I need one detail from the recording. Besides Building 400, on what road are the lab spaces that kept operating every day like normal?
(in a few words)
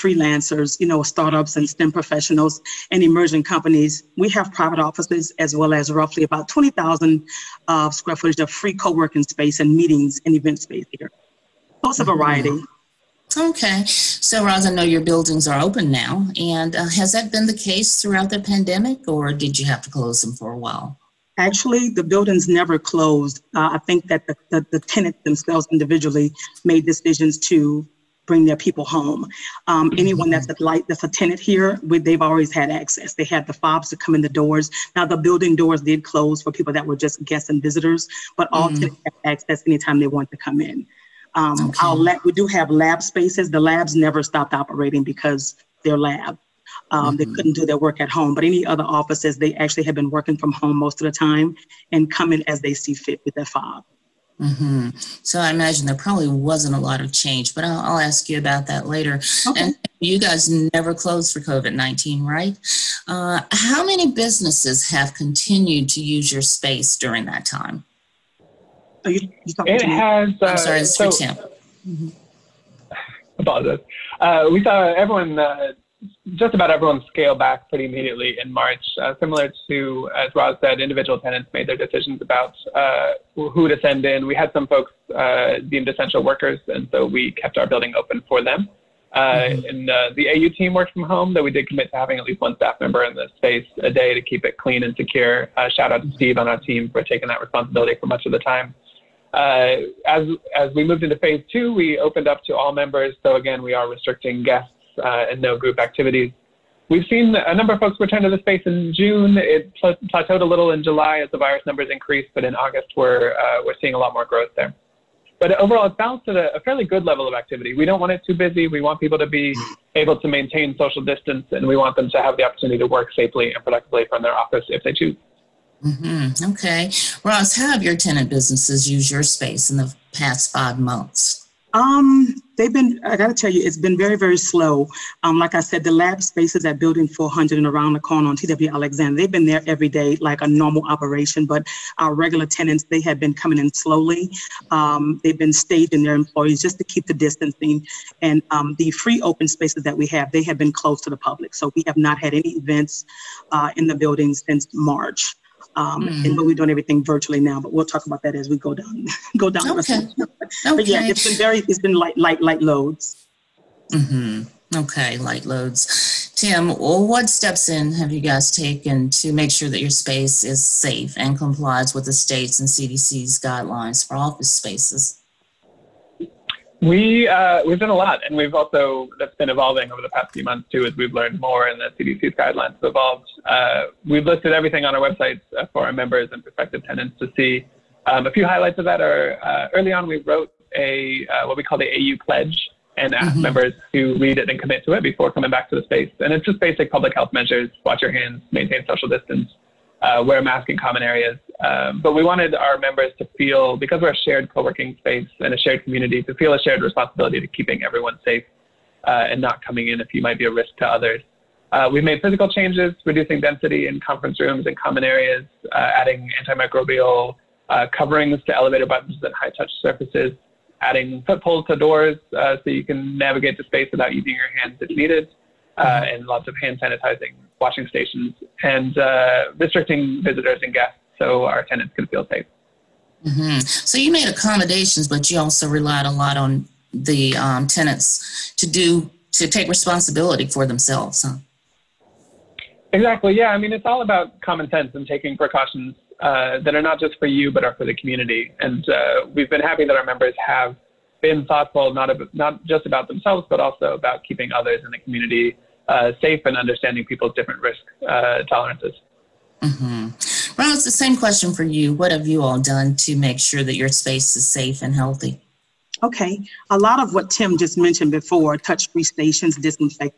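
TW Alexander.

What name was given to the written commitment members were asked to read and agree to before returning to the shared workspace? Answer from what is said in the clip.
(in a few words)
AU pledge.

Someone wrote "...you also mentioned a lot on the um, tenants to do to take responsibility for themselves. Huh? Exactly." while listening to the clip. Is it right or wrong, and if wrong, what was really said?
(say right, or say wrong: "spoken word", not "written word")
wrong: "relied", not "mentioned".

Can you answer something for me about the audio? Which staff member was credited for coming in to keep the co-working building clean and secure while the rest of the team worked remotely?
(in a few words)
Steve.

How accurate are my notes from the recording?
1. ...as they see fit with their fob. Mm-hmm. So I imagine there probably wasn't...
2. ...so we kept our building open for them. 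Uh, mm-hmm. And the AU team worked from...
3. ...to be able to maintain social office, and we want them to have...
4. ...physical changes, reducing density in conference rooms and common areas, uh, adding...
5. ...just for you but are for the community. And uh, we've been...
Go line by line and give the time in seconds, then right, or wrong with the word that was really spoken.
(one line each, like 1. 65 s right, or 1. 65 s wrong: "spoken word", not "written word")
1. 52 s right
2. 86 s right
3. 119 s wrong: "distance", not "office"
4. 212 s right
5. 246 s right.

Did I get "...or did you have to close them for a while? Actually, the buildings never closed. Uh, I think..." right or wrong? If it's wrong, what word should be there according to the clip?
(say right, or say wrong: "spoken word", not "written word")
right.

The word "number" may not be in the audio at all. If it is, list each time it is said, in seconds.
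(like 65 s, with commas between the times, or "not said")
107 s, 111 s.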